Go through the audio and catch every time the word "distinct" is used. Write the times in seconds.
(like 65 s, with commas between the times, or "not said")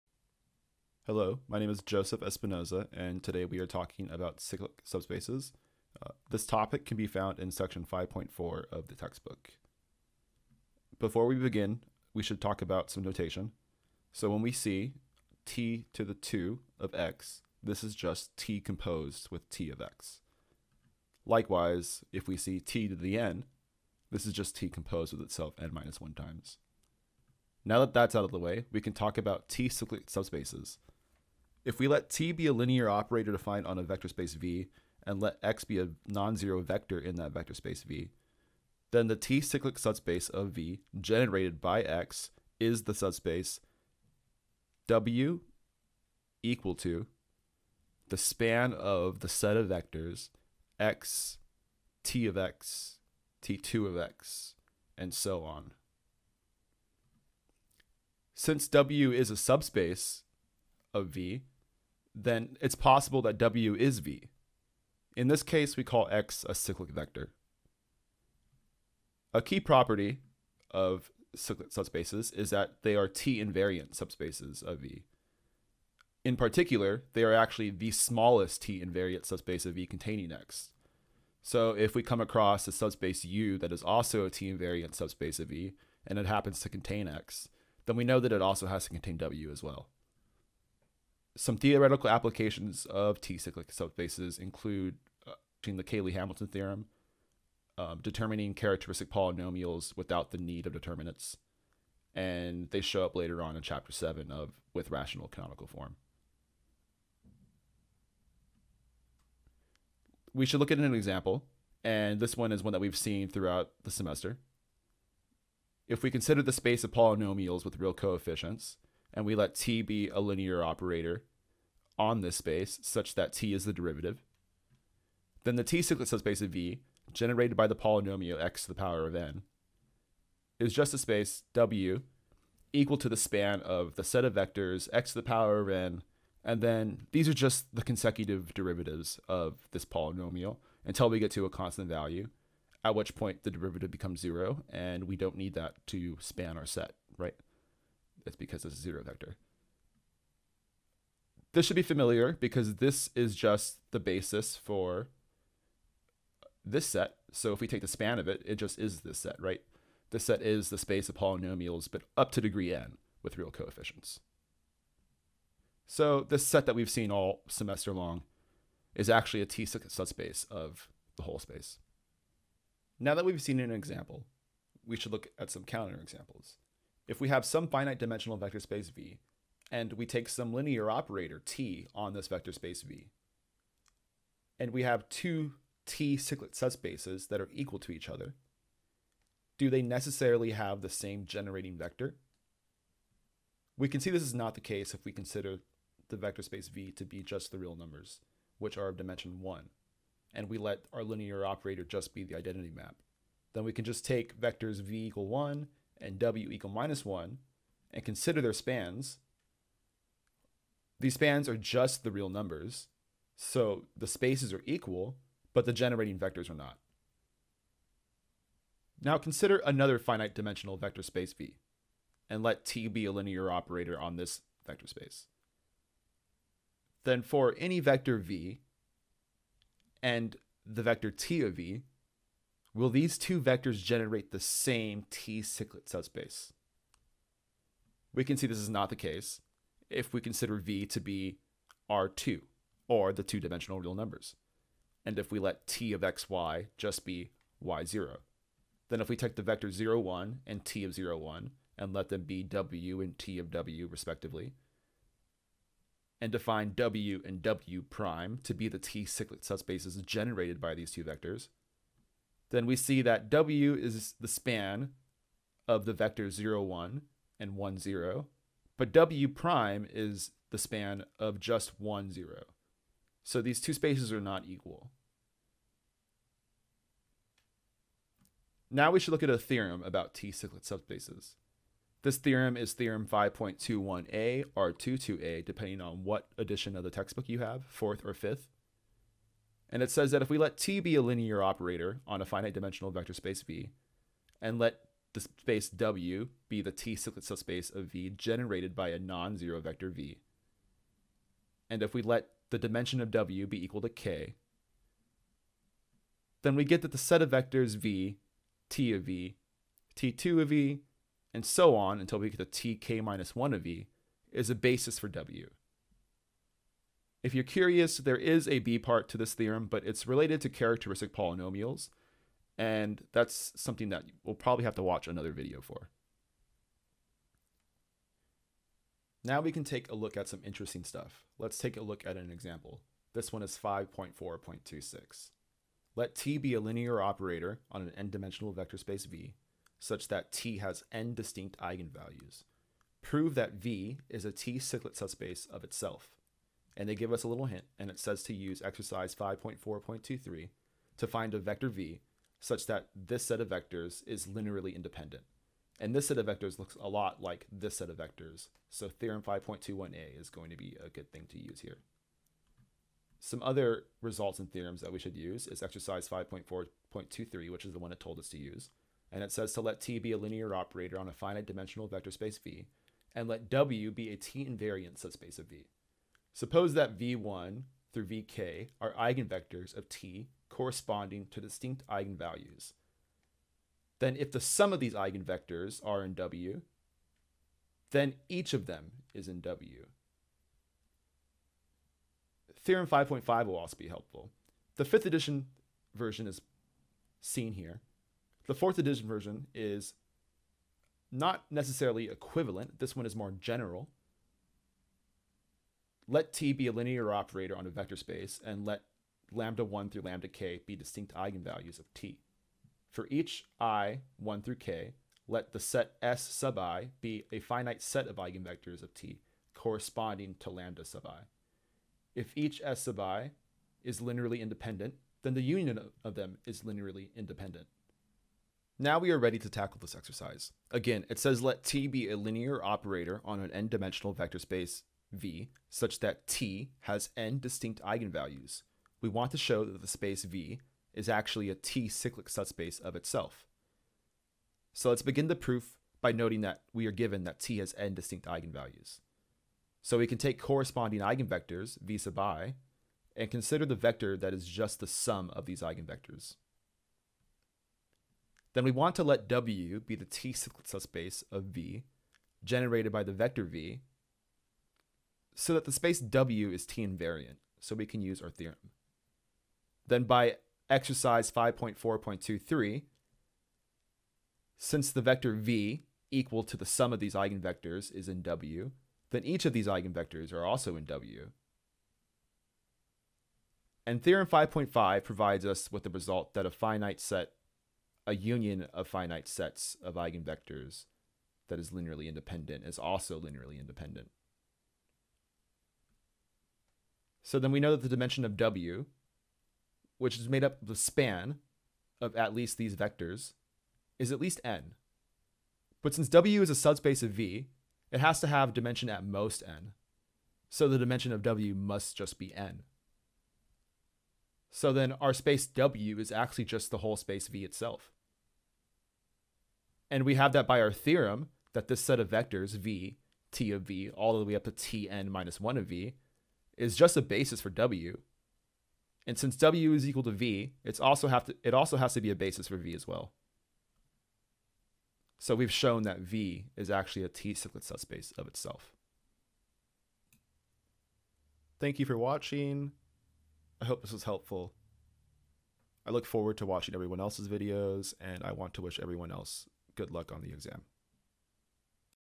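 341 s, 381 s, 410 s, 437 s, 447 s.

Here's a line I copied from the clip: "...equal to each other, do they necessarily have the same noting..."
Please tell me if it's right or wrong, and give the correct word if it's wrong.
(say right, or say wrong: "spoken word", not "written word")
wrong: "generating", not "noting".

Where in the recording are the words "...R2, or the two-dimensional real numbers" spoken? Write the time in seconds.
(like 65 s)
241 s.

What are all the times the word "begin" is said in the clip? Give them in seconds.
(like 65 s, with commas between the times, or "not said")
11 s, 445 s.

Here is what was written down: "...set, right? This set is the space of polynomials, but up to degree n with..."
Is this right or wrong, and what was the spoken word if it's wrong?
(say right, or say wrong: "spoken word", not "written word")
right.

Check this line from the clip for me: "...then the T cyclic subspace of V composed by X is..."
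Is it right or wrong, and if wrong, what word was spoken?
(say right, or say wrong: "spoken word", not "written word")
wrong: "generated", not "composed".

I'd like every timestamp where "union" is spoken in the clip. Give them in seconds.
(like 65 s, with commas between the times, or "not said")
425 s, 488 s.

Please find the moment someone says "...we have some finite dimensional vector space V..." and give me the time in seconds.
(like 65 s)
177 s.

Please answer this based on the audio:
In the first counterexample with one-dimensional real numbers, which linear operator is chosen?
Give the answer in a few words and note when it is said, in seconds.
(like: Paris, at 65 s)
identity map, at 202 s.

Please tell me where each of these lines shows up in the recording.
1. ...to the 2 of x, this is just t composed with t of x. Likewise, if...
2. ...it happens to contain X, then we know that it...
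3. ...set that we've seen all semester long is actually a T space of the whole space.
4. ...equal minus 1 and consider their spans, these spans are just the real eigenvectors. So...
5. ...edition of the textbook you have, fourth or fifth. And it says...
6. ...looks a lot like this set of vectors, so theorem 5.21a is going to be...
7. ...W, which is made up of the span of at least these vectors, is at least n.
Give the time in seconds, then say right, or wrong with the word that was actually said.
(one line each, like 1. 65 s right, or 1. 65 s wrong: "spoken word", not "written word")
1. 15 s right
2. 86 s right
3. 166 s wrong: "subspace", not "space"
4. 206 s wrong: "numbers", not "eigenvectors"
5. 286 s right
6. 356 s right
7. 498 s right.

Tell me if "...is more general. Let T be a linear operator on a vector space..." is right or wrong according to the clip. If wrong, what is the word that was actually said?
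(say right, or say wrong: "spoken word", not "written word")
right.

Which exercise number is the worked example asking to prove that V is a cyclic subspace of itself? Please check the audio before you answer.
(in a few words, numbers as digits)
5.4.26.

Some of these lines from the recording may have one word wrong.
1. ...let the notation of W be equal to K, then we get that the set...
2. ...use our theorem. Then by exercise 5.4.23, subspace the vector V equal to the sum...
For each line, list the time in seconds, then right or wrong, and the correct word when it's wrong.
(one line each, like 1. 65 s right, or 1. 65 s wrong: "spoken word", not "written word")
1. 302 s wrong: "dimension", not "notation"
2. 468 s wrong: "since", not "subspace".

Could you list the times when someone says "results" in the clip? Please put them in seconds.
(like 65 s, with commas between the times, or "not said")
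364 s, 485 s.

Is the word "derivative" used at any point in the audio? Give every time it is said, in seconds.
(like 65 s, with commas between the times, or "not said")
123 s, 138 s, 143 s.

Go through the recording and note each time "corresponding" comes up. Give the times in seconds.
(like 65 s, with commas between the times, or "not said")
380 s, 419 s, 450 s.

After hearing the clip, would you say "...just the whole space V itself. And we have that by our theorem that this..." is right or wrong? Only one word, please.
right.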